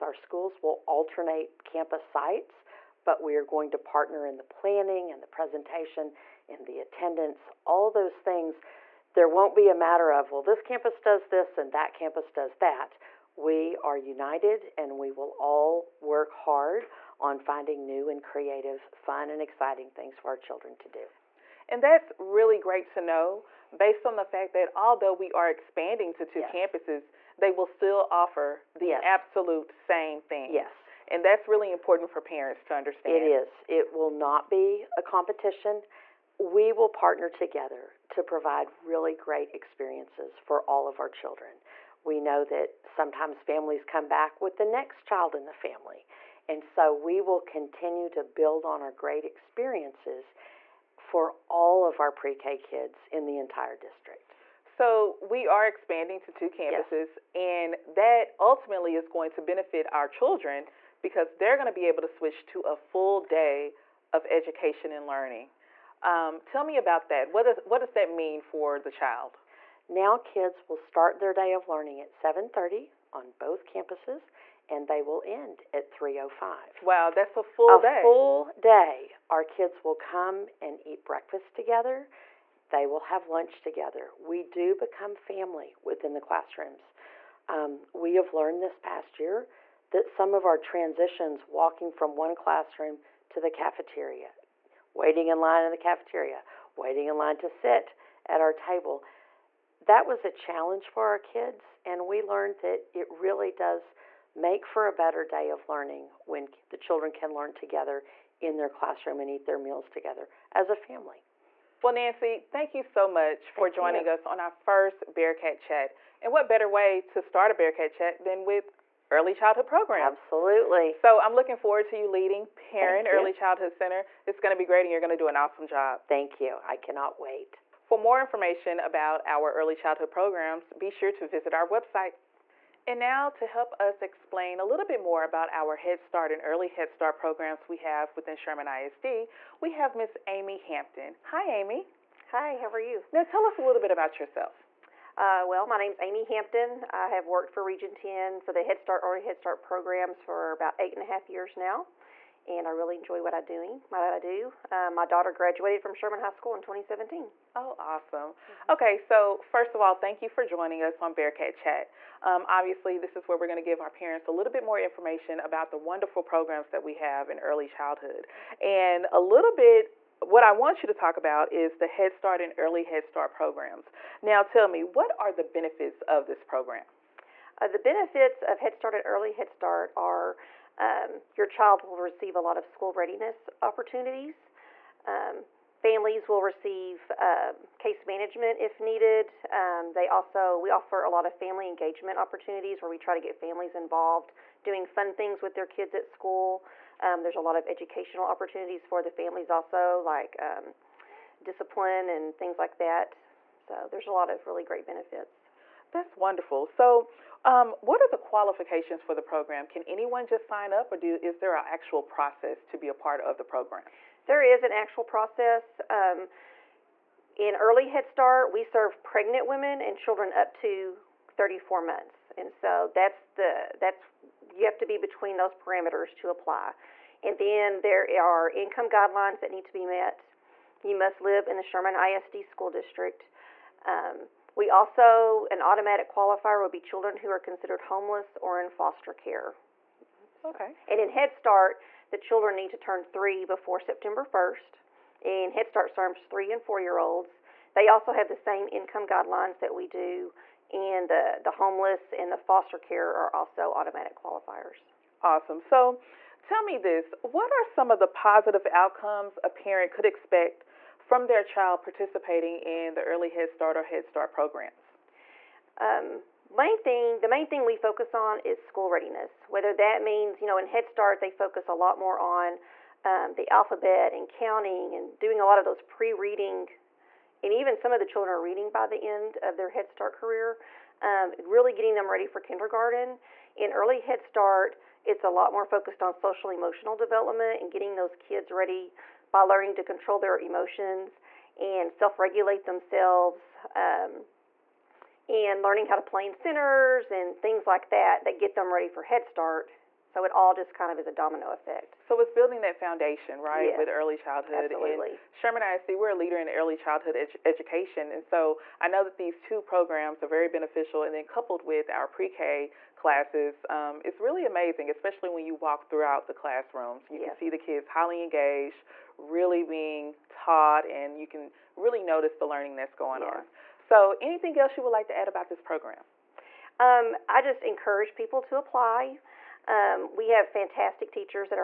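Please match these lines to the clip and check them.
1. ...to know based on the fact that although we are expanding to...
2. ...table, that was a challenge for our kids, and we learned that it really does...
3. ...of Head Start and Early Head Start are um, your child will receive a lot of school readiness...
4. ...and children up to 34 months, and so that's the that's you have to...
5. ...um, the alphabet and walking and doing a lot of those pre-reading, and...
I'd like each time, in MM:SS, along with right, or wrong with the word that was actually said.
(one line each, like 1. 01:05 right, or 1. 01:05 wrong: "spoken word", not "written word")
1. 00:22 right
2. 01:38 right
3. 02:58 right
4. 03:39 right
5. 04:33 wrong: "counting", not "walking".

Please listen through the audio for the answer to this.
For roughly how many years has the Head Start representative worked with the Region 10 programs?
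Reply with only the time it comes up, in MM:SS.
02:30.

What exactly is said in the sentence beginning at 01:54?
us on our first Bearcat Chat.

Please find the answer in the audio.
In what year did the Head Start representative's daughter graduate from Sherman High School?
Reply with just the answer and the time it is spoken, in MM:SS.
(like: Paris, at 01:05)
2017, at 02:36.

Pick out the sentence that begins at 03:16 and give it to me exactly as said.
Um, there's a lot of educational opportunities for the families also, like um, discipline and things like that.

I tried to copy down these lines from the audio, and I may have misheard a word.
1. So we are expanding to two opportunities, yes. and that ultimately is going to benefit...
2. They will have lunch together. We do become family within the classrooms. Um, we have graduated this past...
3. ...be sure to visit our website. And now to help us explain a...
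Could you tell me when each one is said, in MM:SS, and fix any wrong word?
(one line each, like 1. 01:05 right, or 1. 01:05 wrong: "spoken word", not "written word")
1. 00:54 wrong: "campuses", not "opportunities"
2. 01:22 wrong: "learned", not "graduated"
3. 02:10 right.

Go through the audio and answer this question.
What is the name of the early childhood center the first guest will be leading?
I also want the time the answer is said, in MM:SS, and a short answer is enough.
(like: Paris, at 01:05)
Perrin Early Childhood Center, at 02:02.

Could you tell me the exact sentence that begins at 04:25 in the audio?
Um, main thing, the main thing we focus on is school readiness.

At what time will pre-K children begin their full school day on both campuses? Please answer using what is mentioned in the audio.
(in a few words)
7:30.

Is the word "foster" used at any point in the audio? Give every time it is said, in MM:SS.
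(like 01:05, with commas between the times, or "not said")
03:58, 04:12.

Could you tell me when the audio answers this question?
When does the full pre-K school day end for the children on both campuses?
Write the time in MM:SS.
01:15.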